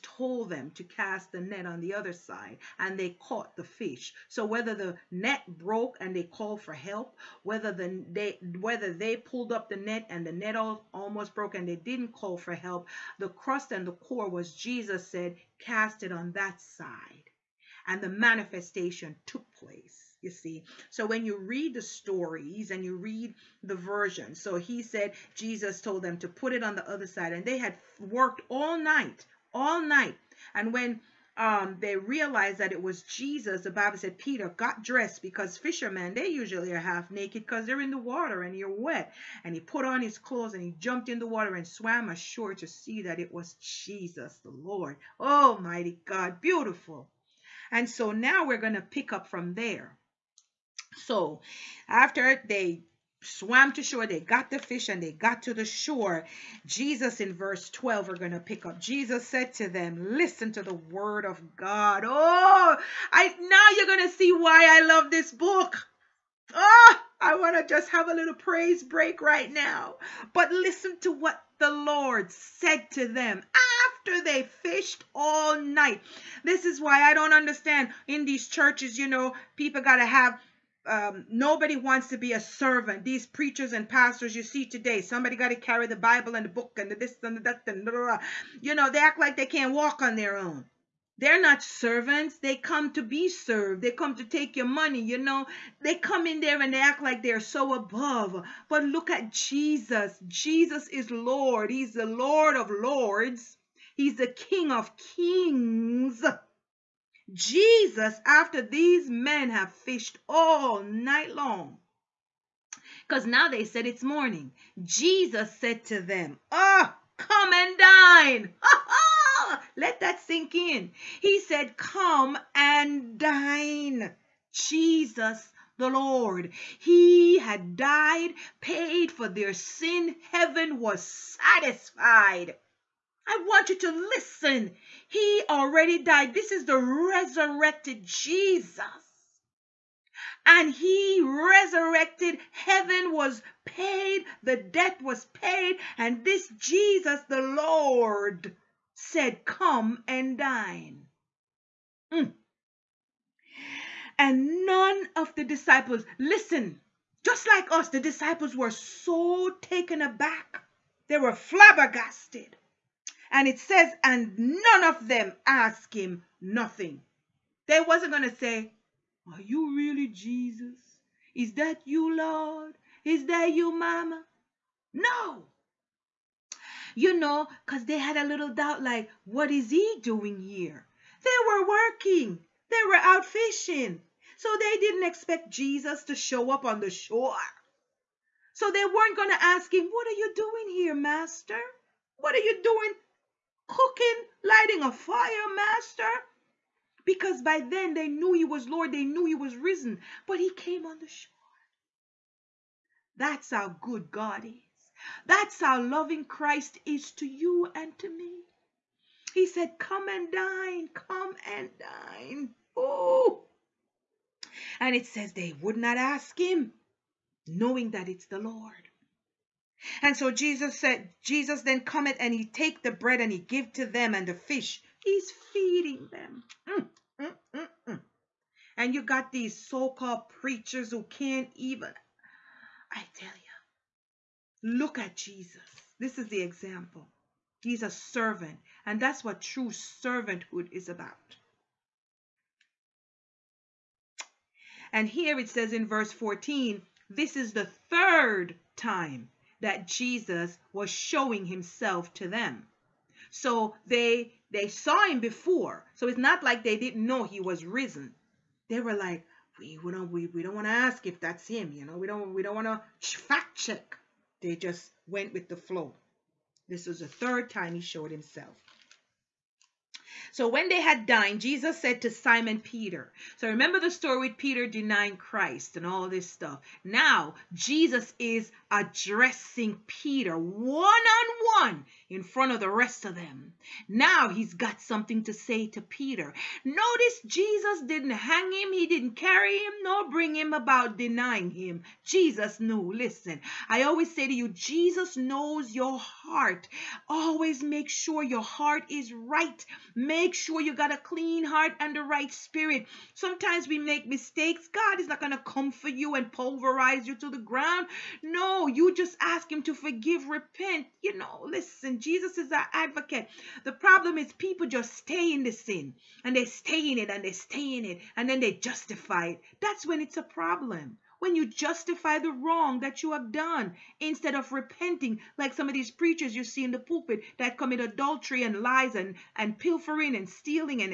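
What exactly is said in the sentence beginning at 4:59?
Make sure you got a clean heart and the right spirit.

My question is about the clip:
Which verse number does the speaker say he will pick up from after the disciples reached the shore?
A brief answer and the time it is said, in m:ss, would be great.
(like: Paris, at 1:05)
12, at 0:57.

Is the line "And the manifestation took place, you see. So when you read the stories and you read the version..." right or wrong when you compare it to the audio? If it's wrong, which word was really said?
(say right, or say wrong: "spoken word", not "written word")
right.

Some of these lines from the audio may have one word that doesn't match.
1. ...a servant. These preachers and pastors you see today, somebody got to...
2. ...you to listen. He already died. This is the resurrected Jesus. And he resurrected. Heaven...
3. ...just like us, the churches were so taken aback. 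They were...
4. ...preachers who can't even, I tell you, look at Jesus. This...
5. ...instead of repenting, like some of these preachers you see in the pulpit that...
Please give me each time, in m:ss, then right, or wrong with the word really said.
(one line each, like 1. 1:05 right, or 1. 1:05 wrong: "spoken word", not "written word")
1. 1:22 right
2. 2:13 right
3. 2:37 wrong: "disciples", not "churches"
4. 3:50 right
5. 5:24 right.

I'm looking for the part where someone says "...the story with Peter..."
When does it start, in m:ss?
4:33.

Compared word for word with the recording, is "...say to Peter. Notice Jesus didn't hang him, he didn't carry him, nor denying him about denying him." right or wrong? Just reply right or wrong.
wrong.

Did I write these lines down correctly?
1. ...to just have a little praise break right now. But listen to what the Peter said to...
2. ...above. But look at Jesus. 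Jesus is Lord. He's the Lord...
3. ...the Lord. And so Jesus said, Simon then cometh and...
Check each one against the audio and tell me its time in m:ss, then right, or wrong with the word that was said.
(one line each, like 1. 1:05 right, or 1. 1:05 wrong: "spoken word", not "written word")
1. 1:07 wrong: "Lord", not "Peter"
2. 1:37 right
3. 3:38 wrong: "Jesus", not "Simon".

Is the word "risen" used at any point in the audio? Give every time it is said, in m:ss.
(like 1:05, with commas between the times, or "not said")
3:19, 4:17.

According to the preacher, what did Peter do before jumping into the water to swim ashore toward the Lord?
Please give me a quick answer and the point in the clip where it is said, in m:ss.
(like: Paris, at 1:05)
Put on his clothes, at 0:39.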